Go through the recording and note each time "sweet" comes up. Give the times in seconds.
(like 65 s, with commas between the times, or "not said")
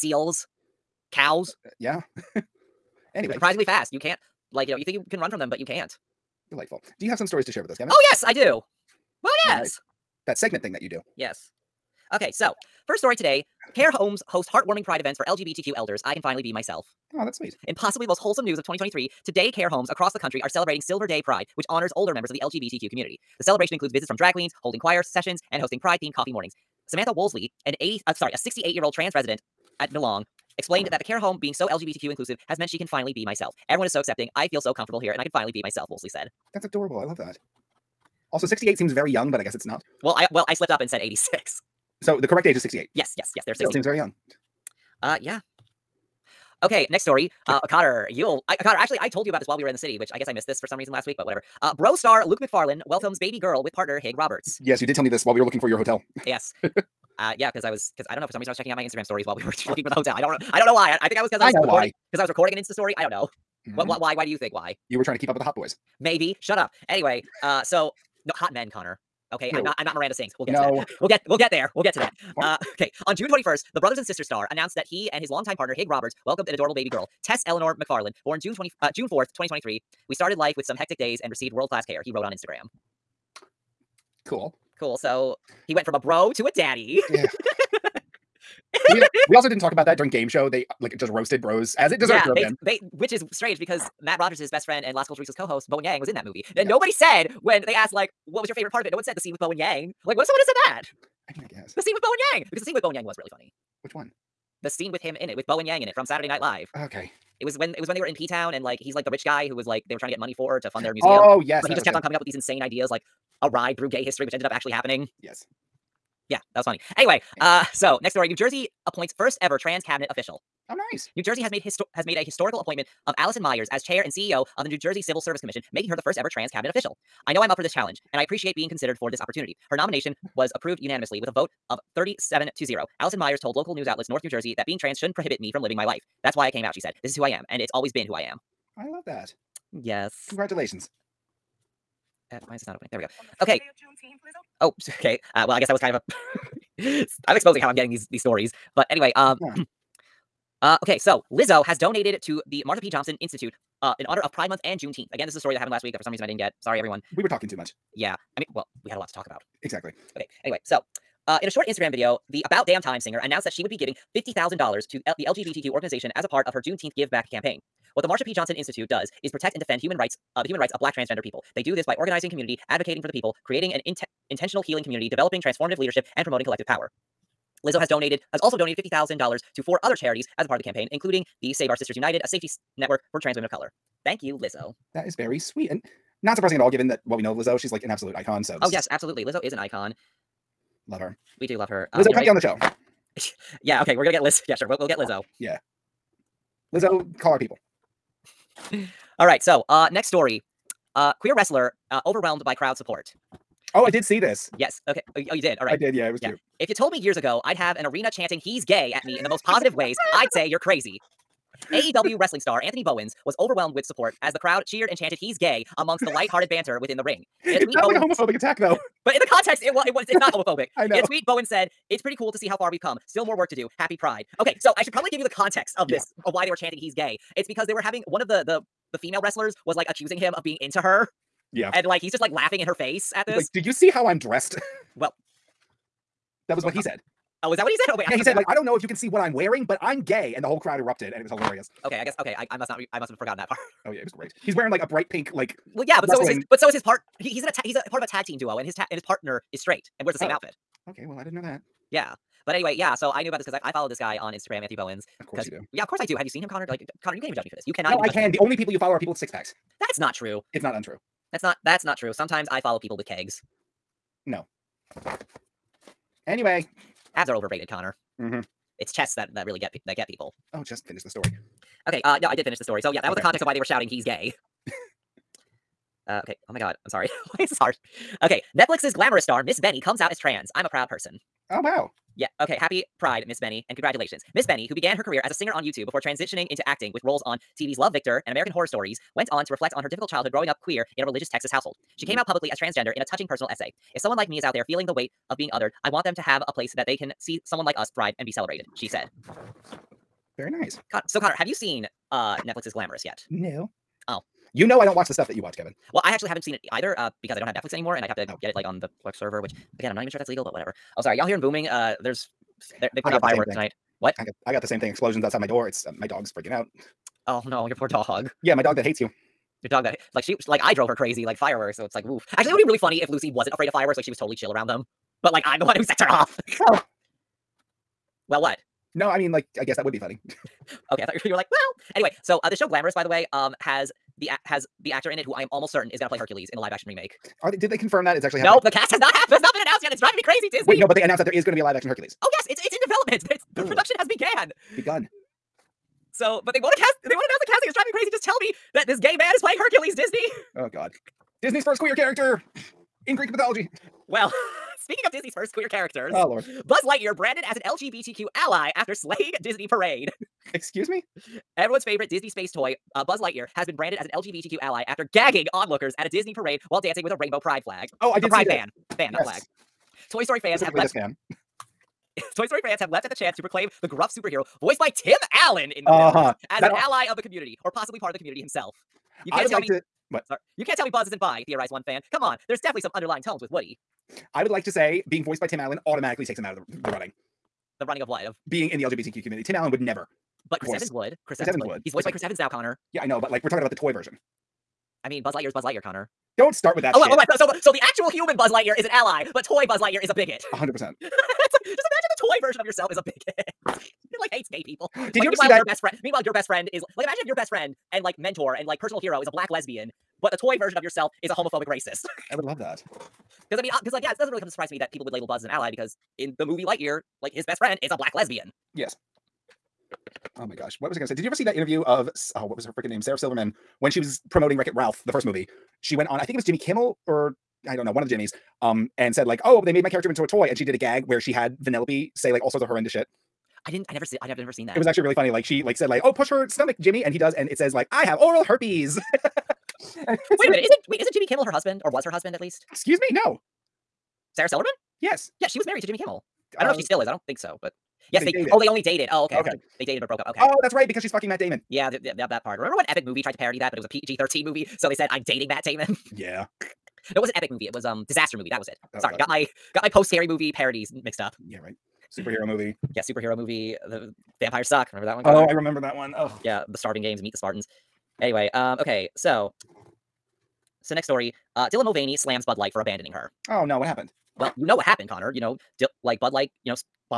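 17 s, 185 s.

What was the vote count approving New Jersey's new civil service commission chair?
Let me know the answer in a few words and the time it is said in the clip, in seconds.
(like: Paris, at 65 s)
37 to 0, at 131 s.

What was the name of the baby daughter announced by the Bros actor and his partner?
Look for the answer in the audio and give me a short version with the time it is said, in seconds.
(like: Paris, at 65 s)
Tess Eleanor McFarlane, at 77 s.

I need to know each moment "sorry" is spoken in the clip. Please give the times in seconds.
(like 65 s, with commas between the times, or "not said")
28 s, 156 s, 276 s, 311 s, 380 s, 458 s.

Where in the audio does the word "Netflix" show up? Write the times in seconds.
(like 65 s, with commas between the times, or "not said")
278 s, 302 s, 307 s.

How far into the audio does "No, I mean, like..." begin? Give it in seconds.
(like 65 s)
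328 s.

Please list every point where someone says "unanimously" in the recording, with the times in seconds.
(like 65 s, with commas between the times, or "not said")
130 s.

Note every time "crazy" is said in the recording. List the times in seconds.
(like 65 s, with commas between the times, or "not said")
210 s, 320 s, 340 s, 347 s.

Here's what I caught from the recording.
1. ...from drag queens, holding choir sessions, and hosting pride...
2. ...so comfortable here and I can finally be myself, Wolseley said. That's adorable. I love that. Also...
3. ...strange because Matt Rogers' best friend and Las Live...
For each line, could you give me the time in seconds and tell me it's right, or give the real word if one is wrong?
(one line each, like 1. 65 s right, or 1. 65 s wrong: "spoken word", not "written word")
1. 24 s right
2. 34 s right
3. 93 s wrong: "Culturistas", not "Live".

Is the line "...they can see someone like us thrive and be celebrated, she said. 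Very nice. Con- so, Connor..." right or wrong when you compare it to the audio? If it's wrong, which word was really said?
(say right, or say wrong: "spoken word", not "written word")
right.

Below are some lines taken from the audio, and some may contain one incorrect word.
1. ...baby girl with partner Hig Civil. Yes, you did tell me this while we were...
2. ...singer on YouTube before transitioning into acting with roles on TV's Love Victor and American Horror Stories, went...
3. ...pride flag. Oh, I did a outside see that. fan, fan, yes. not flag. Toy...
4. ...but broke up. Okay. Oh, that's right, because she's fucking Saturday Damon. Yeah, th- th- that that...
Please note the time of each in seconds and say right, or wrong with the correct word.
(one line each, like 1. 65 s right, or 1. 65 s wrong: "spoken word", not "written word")
1. 53 s wrong: "Roberts", not "Civil"
2. 285 s right
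3. 367 s wrong: "pride", not "outside"
4. 450 s wrong: "Matt", not "Saturday".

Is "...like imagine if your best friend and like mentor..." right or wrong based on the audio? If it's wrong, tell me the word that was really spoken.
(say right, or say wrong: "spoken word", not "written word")
right.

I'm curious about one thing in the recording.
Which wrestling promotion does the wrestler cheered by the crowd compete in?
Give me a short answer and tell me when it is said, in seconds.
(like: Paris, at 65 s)
AEW, at 211 s.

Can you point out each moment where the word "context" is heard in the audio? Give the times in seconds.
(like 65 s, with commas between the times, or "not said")
219 s, 225 s, 273 s.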